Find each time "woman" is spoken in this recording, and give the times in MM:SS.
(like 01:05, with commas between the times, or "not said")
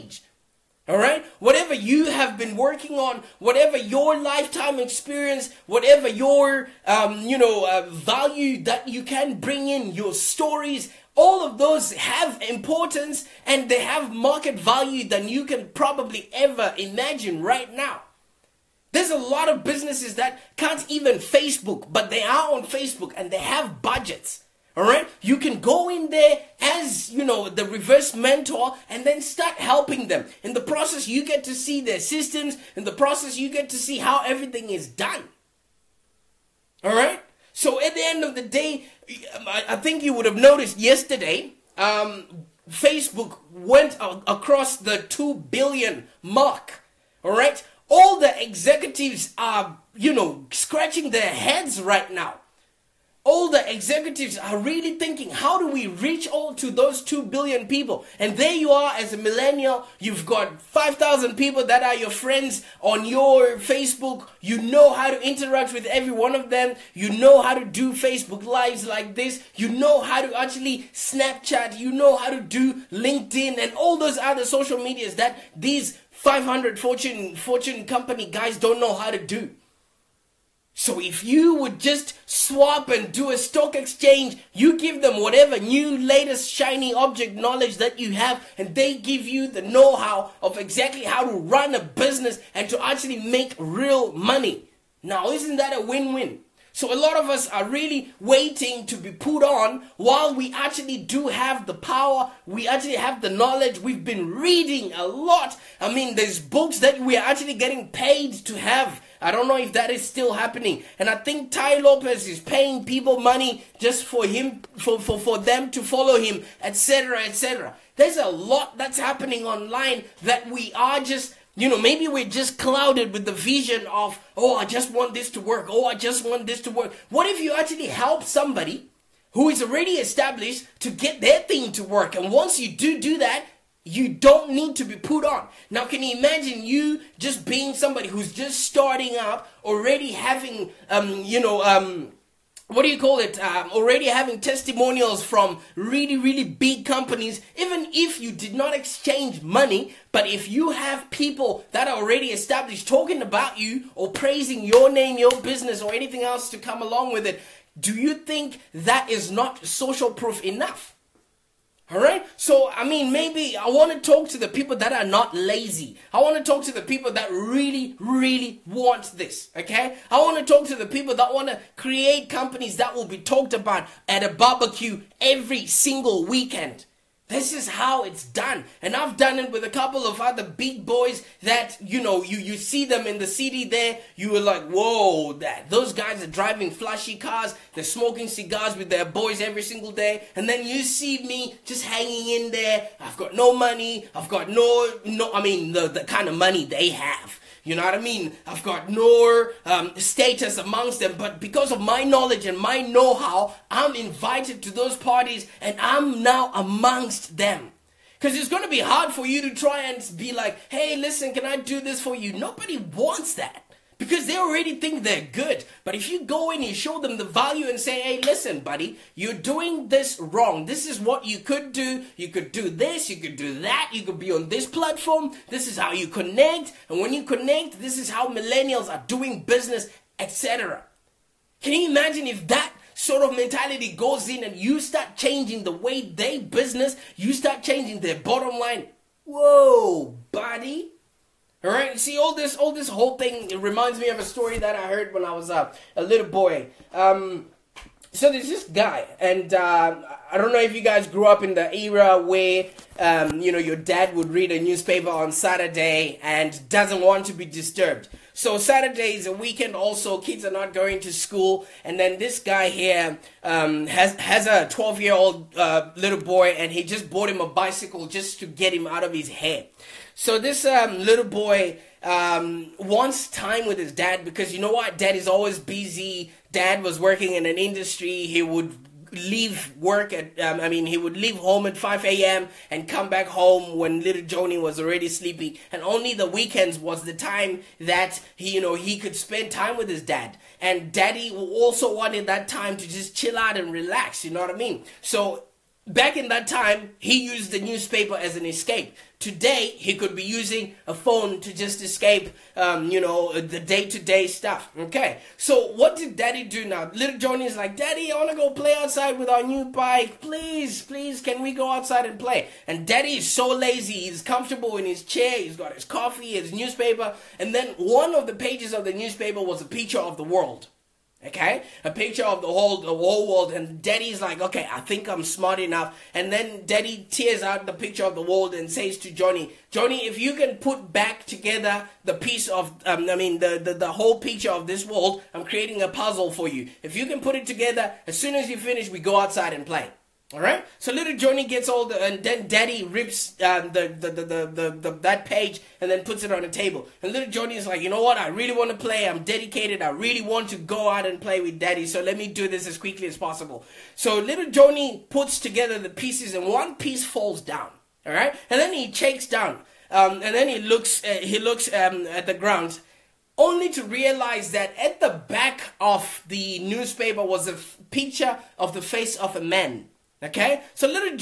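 not said.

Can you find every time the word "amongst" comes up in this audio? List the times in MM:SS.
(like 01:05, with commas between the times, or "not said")
03:20, 03:26.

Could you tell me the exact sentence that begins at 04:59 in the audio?
Today, he could be using a phone to just escape, um, you know, the day to day stuff.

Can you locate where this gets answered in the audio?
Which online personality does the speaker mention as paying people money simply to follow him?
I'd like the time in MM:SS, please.
01:51.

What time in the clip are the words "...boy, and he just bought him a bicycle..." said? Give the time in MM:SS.
04:26.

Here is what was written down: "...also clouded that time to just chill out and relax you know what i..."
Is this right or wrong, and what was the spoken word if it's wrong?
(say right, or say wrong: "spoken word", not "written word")
wrong: "wanted", not "clouded".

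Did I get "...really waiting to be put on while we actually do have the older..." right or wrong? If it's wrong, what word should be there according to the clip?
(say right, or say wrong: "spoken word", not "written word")
wrong: "power", not "older".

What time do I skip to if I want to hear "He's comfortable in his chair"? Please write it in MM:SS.
05:14.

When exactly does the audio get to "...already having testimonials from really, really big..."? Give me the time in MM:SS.
02:23.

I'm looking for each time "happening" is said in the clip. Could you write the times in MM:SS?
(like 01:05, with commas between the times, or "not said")
01:50, 01:58.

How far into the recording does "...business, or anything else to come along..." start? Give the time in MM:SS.
02:35.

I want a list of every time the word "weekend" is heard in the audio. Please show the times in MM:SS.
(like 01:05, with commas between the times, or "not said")
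02:56, 04:19, 04:46.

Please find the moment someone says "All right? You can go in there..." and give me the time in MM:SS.
00:24.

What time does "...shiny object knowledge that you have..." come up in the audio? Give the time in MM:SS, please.
01:26.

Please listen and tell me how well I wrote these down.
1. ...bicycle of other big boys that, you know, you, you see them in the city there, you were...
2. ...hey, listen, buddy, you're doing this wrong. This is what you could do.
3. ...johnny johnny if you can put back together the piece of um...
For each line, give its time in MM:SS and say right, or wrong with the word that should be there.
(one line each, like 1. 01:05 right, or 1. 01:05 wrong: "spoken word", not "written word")
1. 02:59 wrong: "couple", not "bicycle"
2. 03:38 right
3. 05:29 right.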